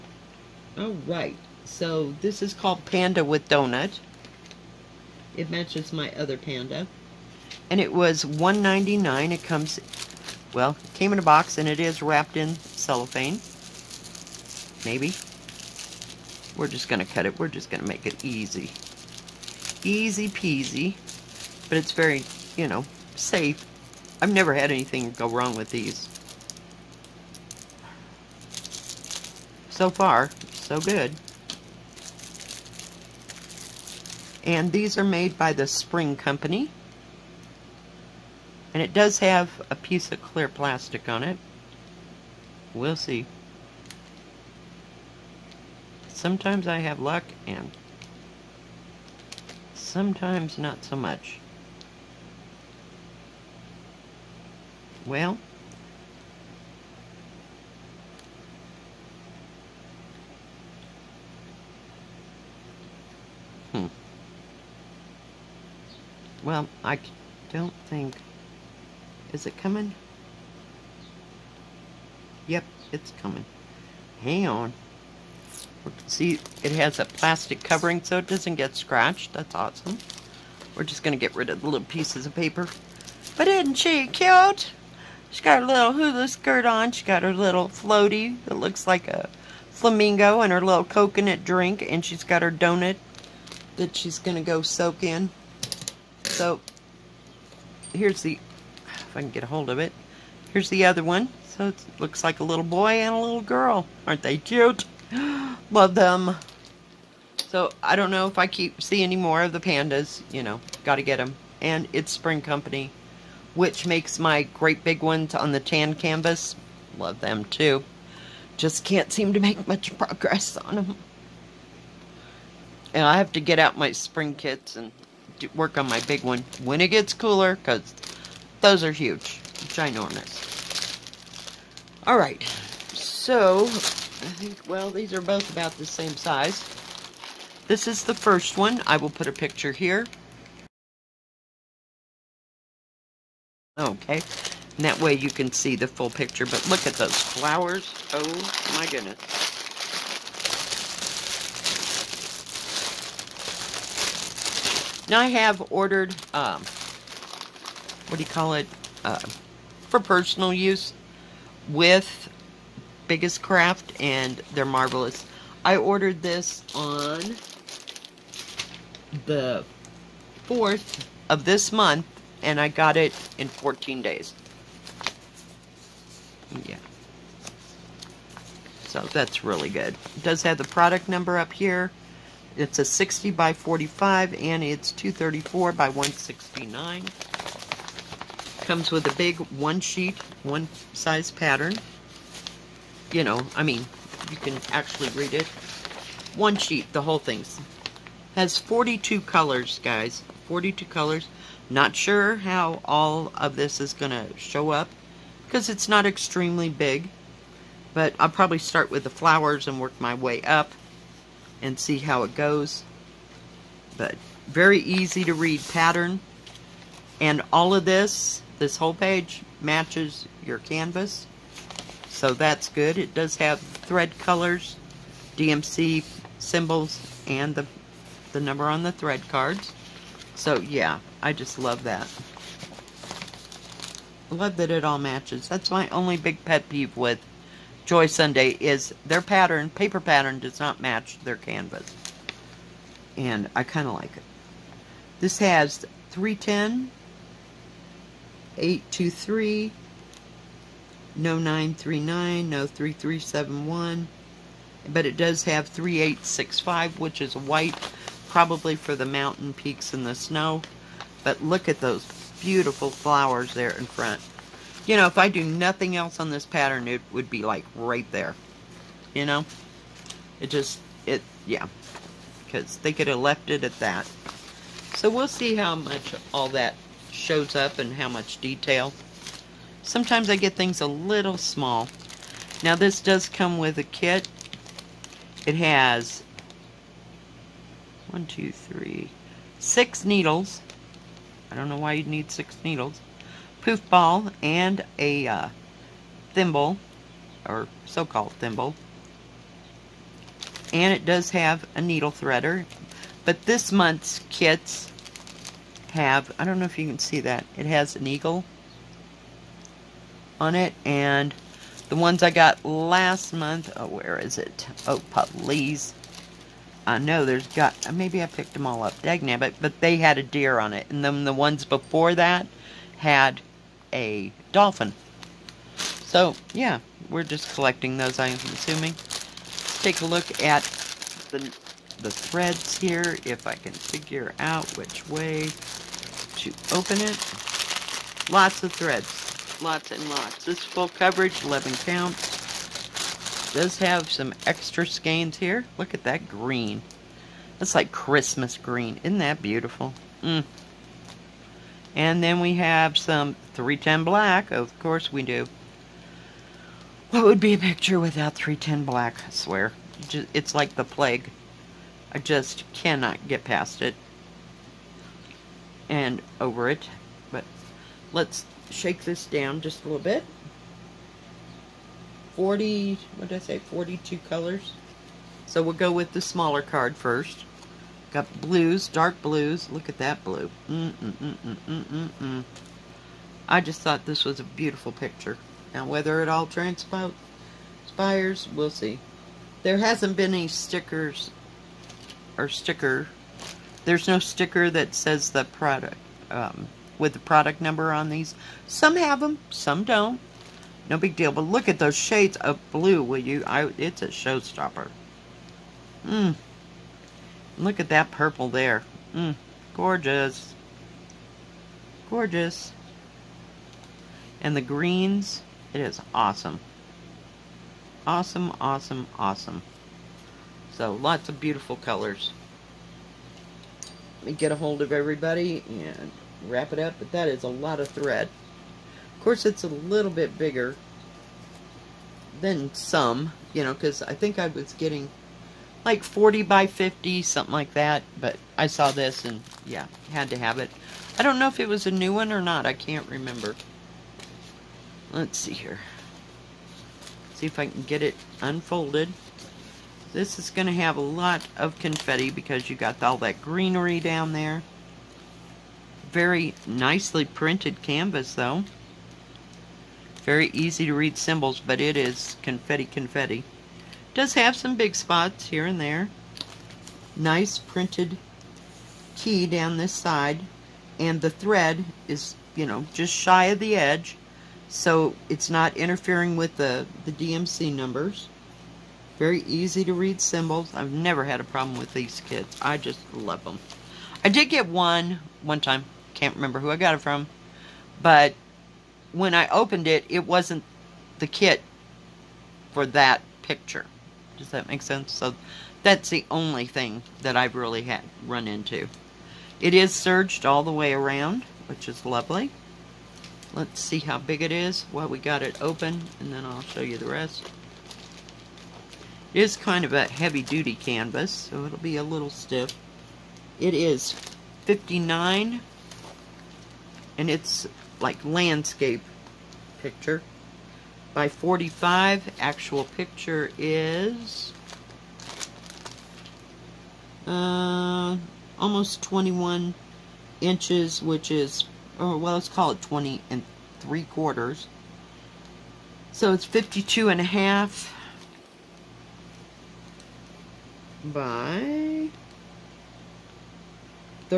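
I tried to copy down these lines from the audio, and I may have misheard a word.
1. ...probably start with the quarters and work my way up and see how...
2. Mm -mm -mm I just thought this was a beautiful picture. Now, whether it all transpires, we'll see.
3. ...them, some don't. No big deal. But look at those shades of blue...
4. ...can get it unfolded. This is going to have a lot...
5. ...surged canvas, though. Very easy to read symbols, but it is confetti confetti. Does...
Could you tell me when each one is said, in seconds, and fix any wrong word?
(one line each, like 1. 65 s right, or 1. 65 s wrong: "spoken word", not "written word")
1. 208 s wrong: "flowers", not "quarters"
2. 380 s right
3. 399 s right
4. 447 s right
5. 457 s wrong: "printed", not "surged".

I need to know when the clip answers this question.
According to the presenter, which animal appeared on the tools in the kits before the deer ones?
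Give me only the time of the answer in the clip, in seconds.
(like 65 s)
324 s.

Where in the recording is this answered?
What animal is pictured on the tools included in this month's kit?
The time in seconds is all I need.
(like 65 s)
308 s.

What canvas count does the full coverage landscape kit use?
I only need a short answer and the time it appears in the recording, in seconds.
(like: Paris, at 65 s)
11, at 341 s.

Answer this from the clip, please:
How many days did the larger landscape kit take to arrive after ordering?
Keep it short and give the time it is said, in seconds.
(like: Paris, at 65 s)
14, at 173 s.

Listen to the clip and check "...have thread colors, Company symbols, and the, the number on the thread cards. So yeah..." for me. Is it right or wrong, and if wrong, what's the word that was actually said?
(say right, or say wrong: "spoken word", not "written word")
wrong: "DMC", not "Company".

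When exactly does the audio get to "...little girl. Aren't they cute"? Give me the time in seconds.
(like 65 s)
103 s.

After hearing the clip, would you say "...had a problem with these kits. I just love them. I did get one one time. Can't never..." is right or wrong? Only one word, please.
wrong.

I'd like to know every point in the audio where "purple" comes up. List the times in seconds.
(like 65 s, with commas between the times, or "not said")
408 s.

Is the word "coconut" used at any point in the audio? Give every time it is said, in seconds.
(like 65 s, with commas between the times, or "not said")
90 s.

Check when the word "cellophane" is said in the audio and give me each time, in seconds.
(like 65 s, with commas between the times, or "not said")
12 s.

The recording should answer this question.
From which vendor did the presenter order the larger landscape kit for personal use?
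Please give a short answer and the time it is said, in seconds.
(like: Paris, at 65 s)
Biggest Craft, at 163 s.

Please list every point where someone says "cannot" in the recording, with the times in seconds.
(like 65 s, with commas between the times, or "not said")
362 s.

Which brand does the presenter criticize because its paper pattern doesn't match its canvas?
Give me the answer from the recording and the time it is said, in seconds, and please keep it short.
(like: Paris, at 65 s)
Joy Sunday, at 237 s.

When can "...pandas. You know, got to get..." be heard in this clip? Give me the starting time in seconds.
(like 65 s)
109 s.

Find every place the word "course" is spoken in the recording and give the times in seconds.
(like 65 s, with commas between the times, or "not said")
354 s, 429 s.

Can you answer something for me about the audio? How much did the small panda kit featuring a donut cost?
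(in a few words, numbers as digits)
$1.99.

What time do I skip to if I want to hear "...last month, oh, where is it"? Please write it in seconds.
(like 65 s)
312 s.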